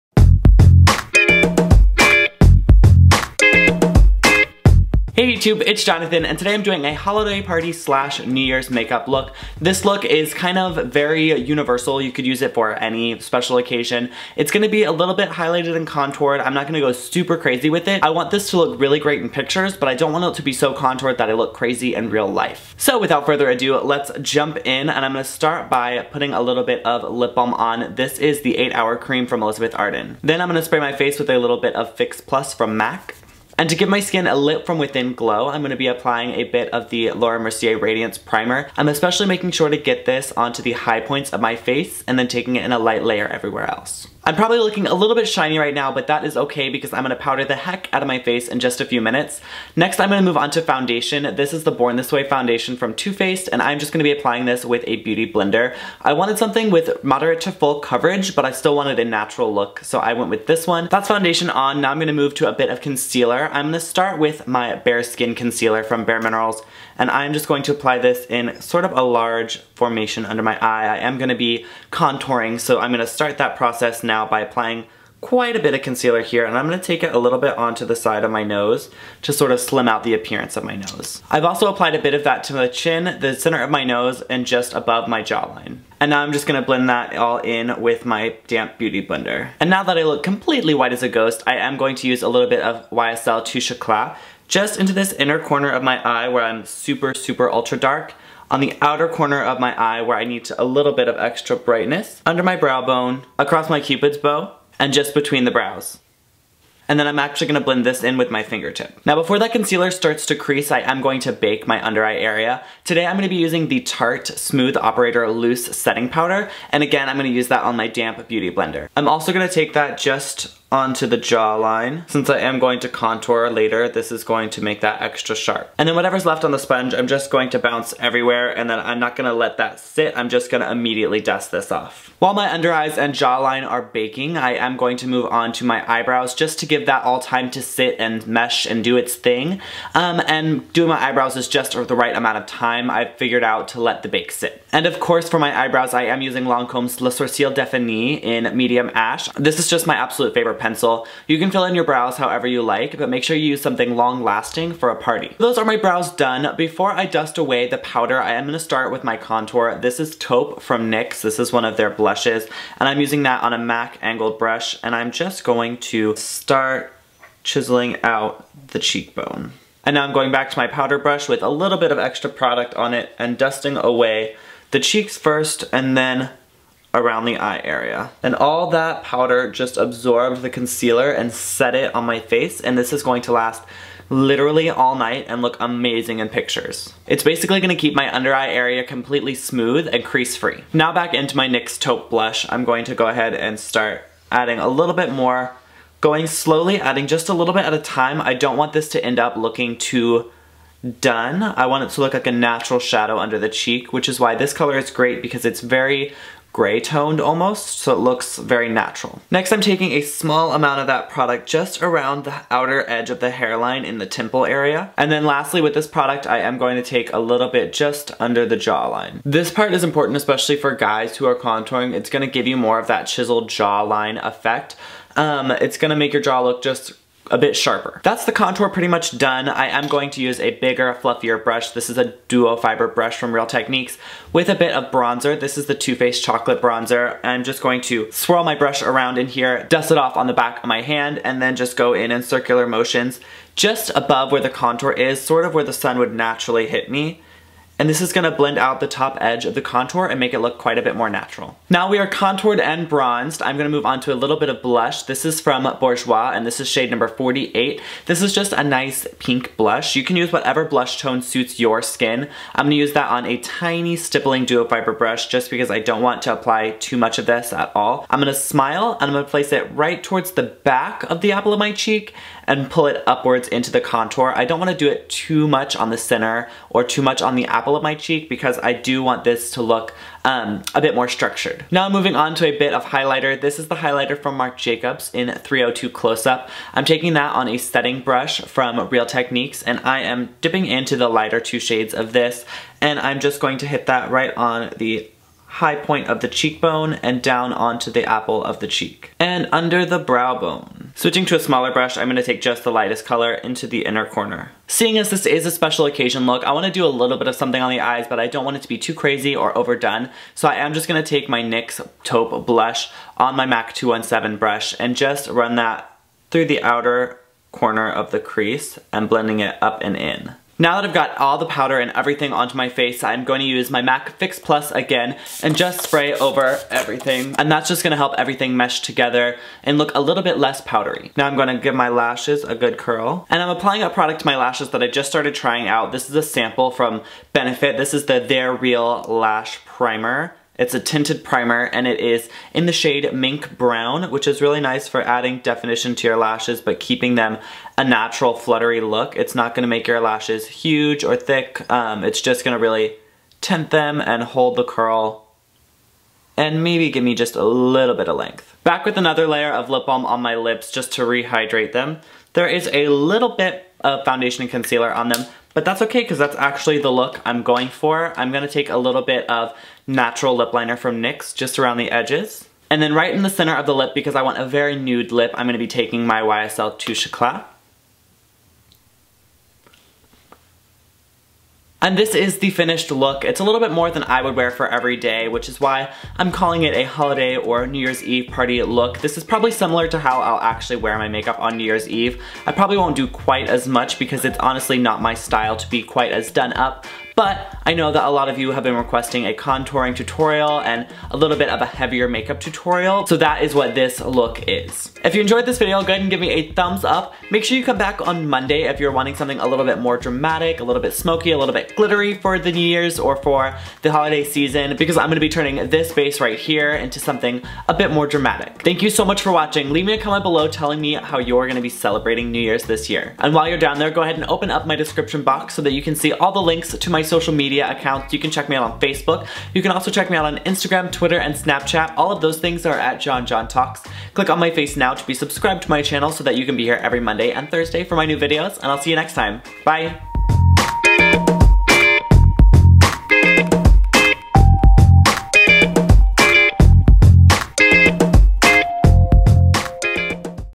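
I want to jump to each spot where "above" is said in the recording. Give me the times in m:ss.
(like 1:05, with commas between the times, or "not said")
1:24, 4:03.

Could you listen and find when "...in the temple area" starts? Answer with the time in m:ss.
3:33.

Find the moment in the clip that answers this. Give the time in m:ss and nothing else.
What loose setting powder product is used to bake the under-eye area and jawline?
1:53.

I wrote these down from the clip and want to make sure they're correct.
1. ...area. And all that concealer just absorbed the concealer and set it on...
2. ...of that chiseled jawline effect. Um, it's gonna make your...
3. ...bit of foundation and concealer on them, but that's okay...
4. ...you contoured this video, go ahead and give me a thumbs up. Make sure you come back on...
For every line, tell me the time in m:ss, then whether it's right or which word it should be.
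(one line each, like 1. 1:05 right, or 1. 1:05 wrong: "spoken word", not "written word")
1. 2:57 wrong: "powder", not "concealer"
2. 3:42 right
3. 6:03 right
4. 6:45 wrong: "enjoyed", not "contoured".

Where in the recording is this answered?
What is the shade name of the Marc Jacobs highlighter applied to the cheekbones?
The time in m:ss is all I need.
4:45.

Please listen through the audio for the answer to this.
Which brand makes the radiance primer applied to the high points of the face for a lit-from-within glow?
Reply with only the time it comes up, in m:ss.
0:37.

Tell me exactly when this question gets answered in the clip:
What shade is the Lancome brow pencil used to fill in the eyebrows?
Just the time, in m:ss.
2:28.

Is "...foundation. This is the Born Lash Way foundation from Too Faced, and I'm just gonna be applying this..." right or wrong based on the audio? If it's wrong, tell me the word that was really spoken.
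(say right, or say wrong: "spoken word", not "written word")
wrong: "This", not "Lash".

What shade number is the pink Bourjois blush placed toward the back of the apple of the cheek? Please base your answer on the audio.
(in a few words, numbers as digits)
48.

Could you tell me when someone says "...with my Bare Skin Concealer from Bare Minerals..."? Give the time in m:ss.
1:04.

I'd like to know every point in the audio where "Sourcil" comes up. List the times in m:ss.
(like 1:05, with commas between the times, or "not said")
2:27.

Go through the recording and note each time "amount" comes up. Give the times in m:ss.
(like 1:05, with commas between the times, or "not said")
2:22, 3:30.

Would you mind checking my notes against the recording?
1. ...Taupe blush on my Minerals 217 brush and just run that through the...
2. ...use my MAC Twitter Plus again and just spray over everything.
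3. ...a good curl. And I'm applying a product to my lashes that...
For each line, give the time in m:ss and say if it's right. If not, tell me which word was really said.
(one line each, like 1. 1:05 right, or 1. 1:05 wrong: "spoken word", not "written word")
1. 5:12 wrong: "MAC", not "Minerals"
2. 5:23 wrong: "Fix", not "Twitter"
3. 5:32 right.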